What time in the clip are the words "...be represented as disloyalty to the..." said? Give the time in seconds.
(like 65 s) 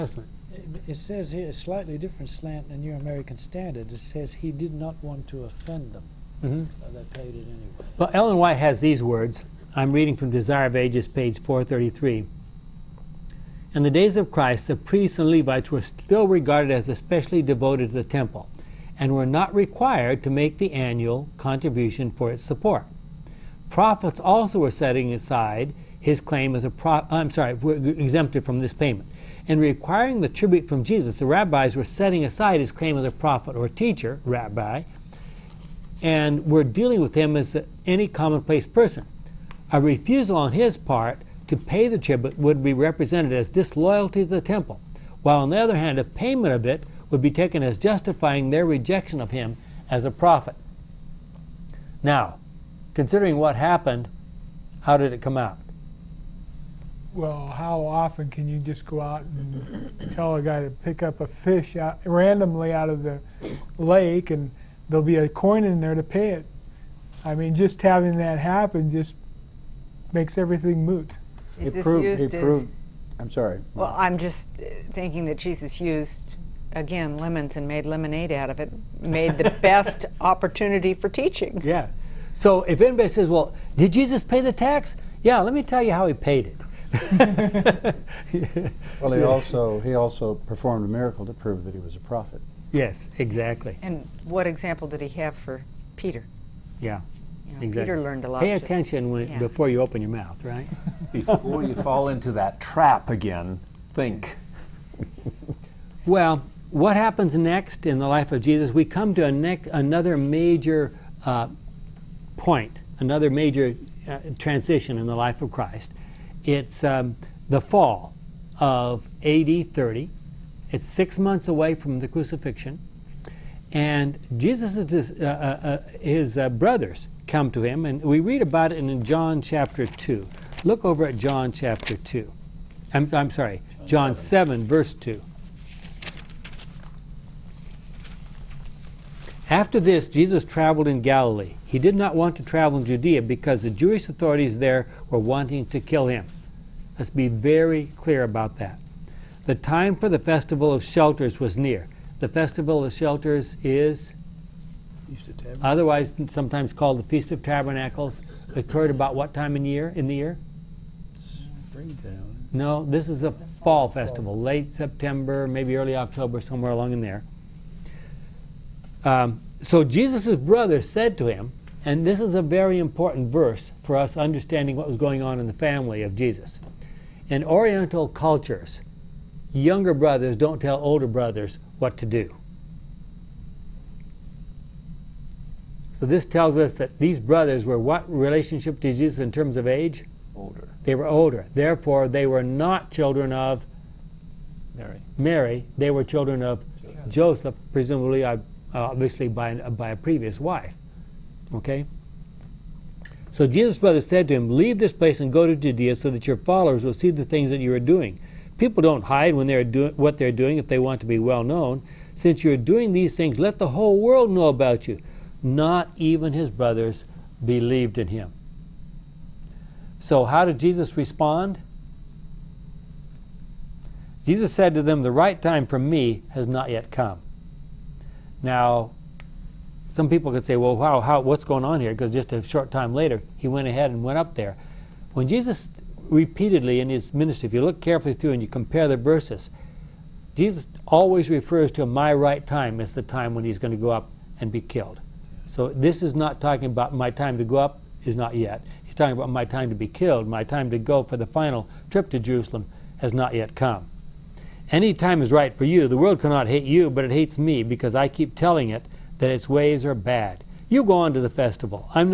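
42 s.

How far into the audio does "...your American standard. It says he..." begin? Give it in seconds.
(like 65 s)
2 s.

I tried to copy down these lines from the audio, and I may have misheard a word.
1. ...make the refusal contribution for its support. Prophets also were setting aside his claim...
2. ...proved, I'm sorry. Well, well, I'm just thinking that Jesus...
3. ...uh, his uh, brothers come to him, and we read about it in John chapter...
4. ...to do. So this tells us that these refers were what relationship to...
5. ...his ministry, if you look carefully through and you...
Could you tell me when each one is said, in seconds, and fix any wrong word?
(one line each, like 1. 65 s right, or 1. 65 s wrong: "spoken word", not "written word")
1. 20 s wrong: "annual", not "refusal"
2. 72 s right
3. 125 s right
4. 181 s wrong: "brothers", not "refers"
5. 236 s right.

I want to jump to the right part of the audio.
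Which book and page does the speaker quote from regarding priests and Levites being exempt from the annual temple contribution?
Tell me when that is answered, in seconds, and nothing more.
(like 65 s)
10 s.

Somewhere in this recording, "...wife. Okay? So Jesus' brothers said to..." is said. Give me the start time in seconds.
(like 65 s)
200 s.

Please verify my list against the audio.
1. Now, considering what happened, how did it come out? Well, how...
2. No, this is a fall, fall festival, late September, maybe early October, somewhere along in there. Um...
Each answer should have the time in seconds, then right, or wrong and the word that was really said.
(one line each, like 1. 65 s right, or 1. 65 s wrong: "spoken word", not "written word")
1. 52 s right
2. 162 s right.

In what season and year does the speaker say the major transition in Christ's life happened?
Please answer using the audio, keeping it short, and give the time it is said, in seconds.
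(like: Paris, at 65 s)
Fall of AD 30, at 117 s.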